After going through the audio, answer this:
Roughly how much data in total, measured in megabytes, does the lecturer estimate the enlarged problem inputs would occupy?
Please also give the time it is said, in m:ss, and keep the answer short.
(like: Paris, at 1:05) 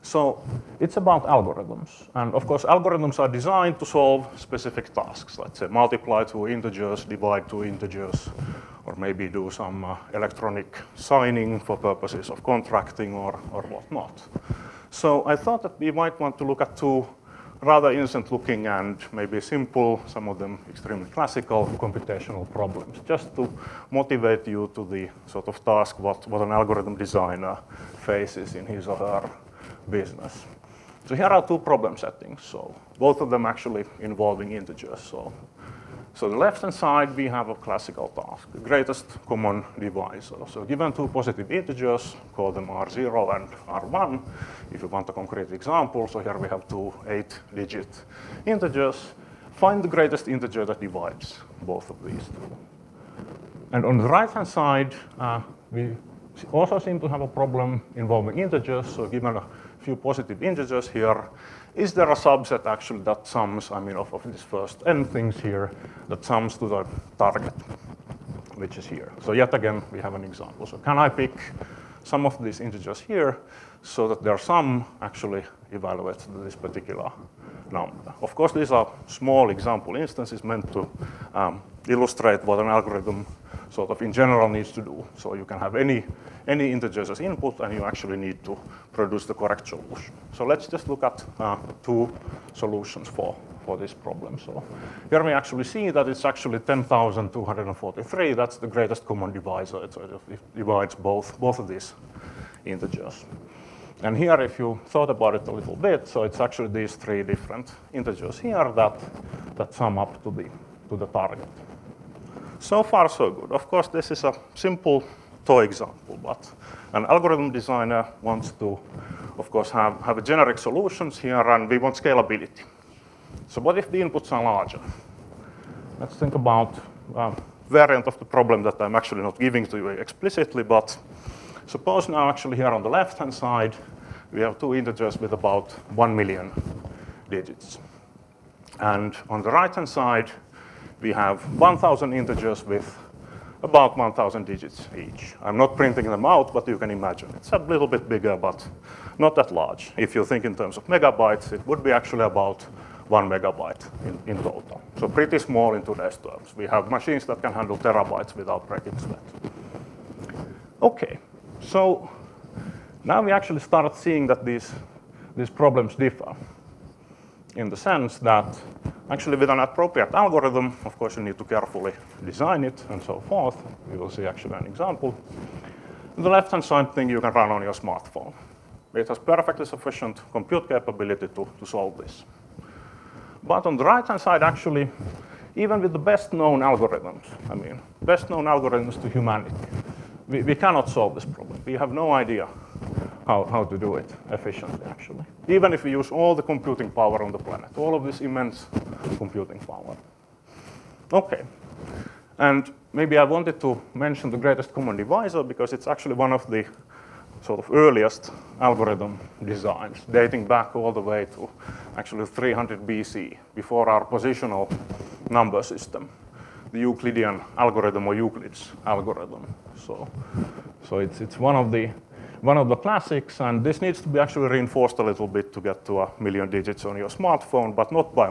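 1 megabyte, at 2:33.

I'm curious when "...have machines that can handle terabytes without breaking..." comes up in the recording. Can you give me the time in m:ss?
2:36.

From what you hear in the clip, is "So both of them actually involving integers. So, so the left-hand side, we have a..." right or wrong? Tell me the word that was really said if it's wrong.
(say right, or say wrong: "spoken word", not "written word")
right.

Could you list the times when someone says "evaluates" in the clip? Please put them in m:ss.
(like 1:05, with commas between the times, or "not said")
1:15.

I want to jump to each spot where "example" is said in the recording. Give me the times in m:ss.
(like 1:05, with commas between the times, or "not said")
0:45, 1:10, 1:19, 1:55, 2:54.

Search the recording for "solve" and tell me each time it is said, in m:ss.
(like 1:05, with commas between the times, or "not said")
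0:03, 3:01, 3:10.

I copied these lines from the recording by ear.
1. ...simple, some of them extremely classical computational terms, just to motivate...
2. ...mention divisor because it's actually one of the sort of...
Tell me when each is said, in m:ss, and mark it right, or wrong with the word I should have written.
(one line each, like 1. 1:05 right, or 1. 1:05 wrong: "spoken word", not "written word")
1. 0:19 wrong: "problems", not "terms"
2. 3:24 wrong: "common", not "mention".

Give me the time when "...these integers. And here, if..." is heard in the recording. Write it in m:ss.
1:41.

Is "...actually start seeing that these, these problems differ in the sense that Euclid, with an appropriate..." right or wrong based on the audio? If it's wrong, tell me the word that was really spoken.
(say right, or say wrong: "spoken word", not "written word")
wrong: "Actually", not "Euclid".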